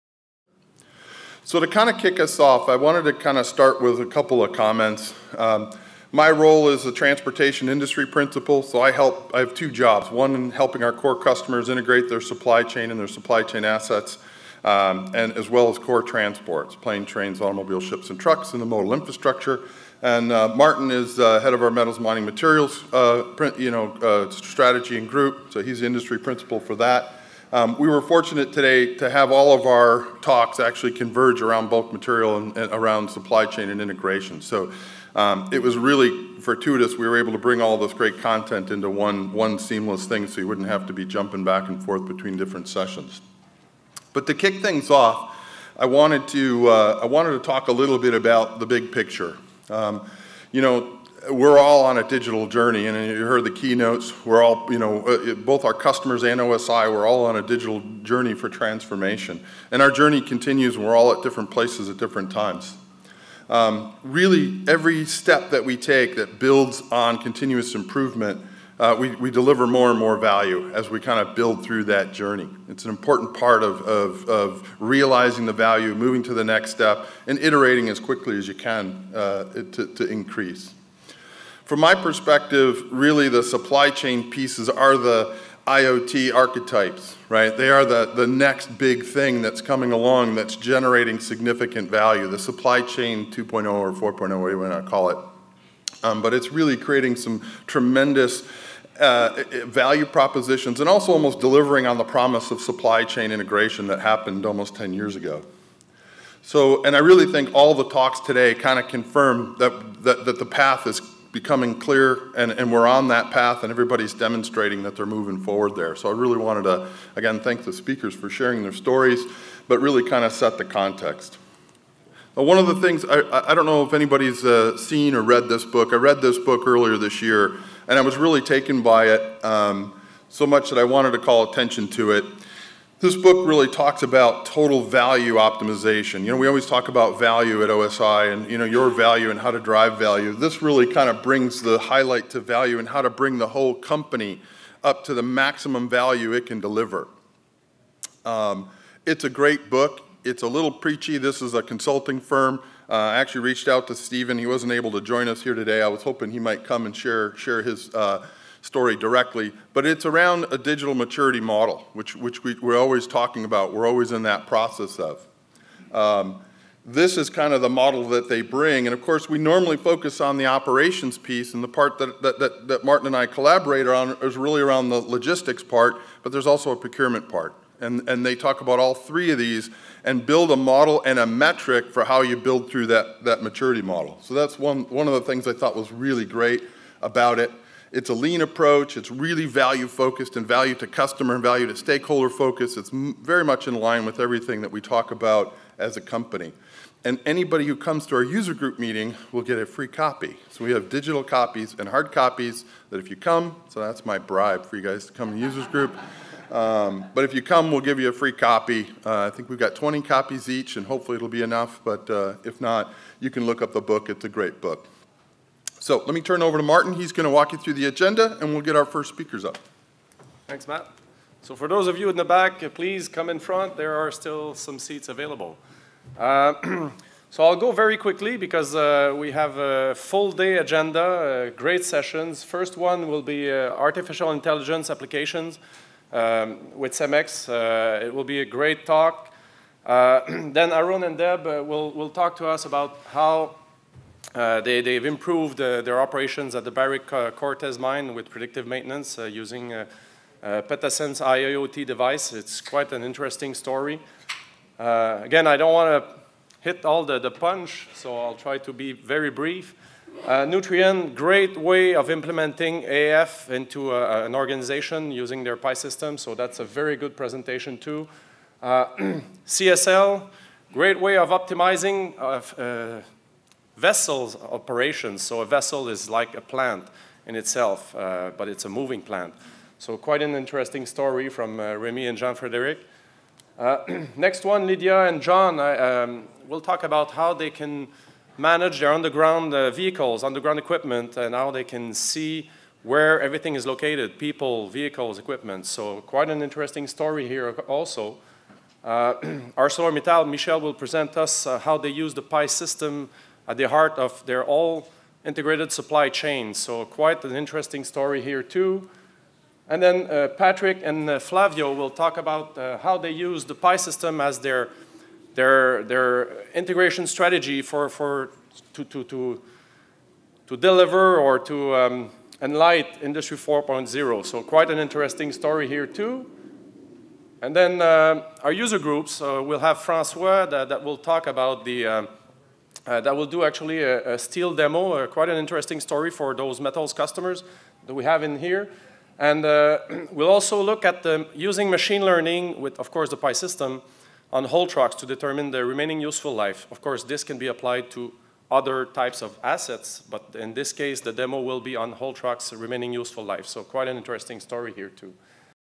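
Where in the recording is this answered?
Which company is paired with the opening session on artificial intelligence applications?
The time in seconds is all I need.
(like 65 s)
236 s.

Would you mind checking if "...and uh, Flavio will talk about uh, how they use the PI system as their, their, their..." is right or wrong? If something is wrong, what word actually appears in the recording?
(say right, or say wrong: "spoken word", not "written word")
right.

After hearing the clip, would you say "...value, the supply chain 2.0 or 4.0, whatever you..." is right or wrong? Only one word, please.
right.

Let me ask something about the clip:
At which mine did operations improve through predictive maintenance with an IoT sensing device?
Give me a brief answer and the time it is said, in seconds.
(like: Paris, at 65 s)
Cortez, at 247 s.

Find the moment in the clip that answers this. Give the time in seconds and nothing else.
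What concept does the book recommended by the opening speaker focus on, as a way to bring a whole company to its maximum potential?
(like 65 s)
134 s.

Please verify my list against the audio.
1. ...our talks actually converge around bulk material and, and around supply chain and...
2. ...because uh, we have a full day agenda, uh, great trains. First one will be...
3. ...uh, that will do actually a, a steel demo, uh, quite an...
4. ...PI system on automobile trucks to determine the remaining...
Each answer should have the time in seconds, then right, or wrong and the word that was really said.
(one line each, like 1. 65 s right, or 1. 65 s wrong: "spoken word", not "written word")
1. 29 s right
2. 228 s wrong: "sessions", not "trains"
3. 332 s right
4. 343 s wrong: "whole", not "automobile".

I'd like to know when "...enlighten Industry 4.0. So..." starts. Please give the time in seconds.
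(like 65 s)
322 s.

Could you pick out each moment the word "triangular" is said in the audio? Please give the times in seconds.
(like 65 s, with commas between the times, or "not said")
not said.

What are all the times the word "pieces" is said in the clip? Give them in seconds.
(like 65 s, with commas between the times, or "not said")
84 s, 171 s.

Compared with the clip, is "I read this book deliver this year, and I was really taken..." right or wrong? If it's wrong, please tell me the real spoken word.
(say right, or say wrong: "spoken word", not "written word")
wrong: "earlier", not "deliver".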